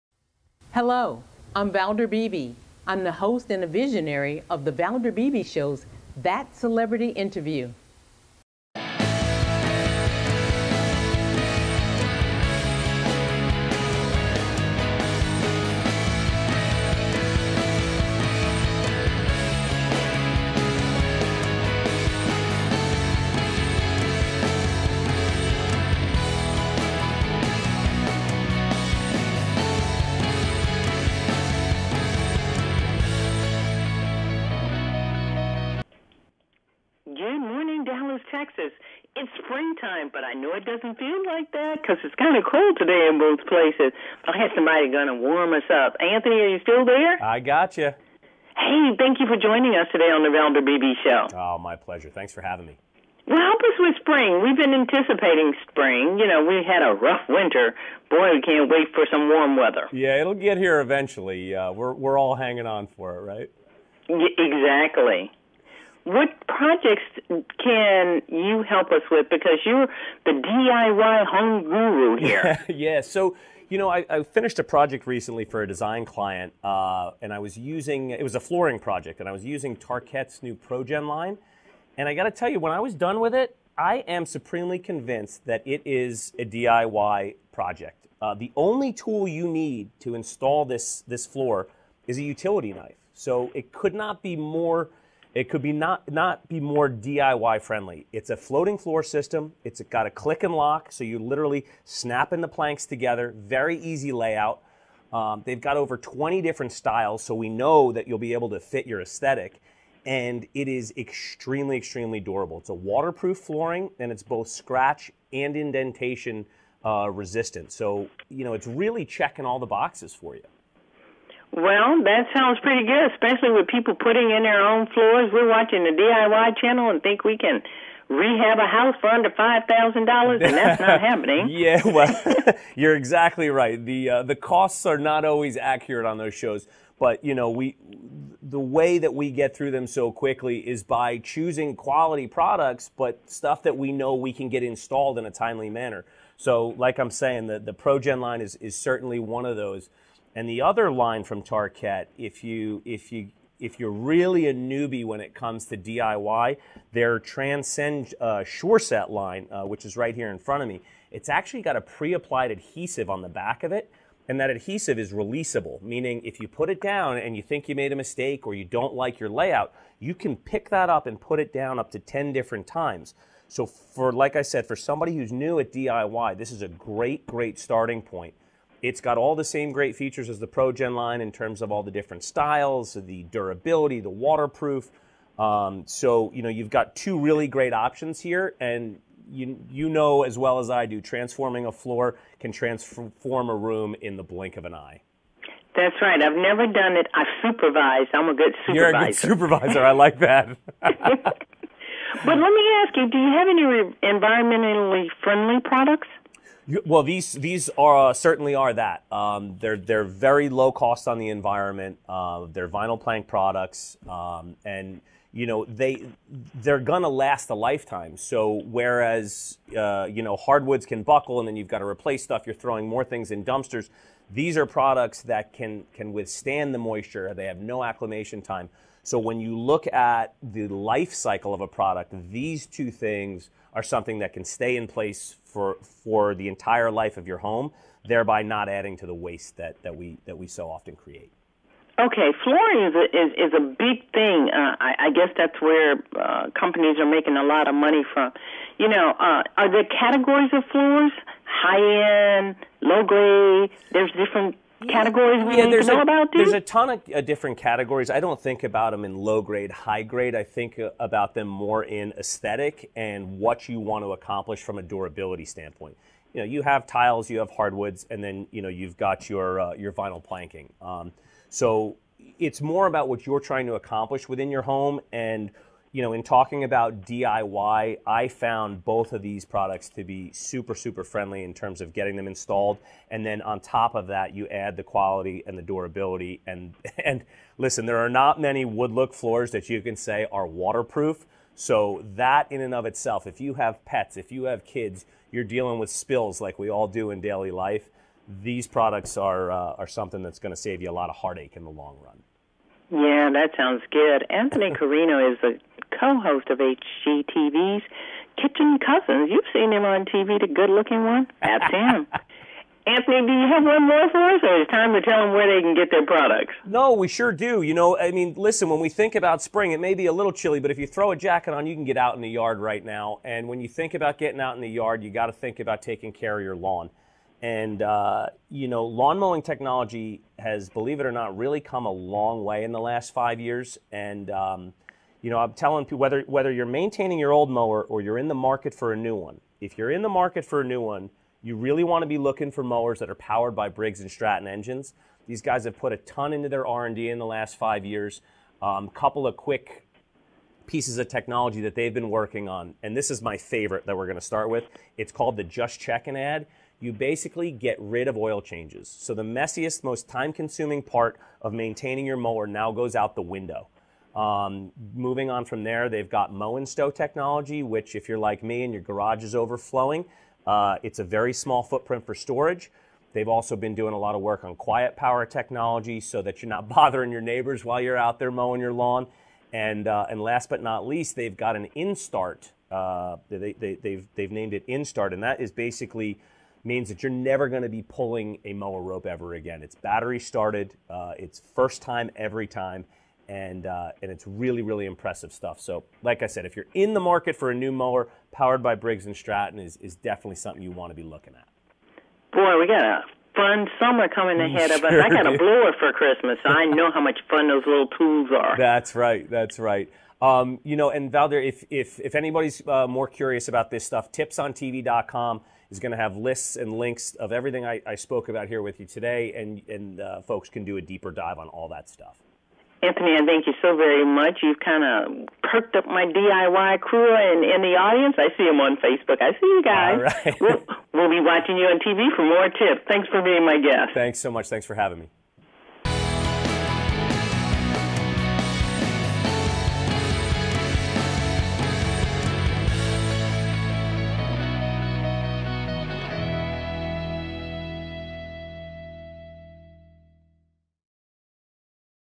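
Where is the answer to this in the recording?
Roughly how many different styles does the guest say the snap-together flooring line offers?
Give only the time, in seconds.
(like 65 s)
105 s.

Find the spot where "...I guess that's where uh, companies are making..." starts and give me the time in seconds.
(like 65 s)
244 s.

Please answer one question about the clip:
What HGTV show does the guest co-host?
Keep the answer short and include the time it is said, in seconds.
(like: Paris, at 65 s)
Kitchen Cousins, at 308 s.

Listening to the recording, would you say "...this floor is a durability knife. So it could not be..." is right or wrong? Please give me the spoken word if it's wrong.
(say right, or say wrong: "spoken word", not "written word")
wrong: "utility", not "durability".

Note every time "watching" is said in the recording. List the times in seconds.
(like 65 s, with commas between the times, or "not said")
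125 s, 431 s.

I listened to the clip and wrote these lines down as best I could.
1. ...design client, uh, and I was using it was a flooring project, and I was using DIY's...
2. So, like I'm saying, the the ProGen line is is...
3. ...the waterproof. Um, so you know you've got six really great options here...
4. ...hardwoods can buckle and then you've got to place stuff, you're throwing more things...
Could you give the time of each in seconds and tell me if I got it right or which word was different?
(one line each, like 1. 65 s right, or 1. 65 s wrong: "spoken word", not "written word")
1. 75 s wrong: "Tarkett", not "DIY"
2. 146 s right
3. 183 s wrong: "two", not "six"
4. 220 s wrong: "replace", not "place".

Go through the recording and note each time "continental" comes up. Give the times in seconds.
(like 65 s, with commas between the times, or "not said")
not said.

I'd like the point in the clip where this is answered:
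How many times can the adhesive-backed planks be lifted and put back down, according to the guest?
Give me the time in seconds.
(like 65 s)
171 s.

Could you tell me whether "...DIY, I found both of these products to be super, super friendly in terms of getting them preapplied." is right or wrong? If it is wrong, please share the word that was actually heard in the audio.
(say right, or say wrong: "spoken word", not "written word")
wrong: "installed", not "preapplied".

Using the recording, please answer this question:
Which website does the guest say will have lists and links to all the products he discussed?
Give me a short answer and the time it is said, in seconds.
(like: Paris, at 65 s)
tipsontv.com, at 414 s.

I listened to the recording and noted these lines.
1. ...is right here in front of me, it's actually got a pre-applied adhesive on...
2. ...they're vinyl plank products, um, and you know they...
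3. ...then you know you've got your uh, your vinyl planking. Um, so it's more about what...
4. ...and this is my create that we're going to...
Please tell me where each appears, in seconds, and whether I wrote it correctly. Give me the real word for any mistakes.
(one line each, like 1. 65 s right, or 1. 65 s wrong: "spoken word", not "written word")
1. 159 s right
2. 212 s right
3. 268 s right
4. 352 s wrong: "favorite", not "create".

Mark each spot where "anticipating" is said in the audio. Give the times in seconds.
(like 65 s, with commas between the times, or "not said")
54 s.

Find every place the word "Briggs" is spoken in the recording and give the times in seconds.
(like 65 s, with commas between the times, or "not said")
343 s, 398 s.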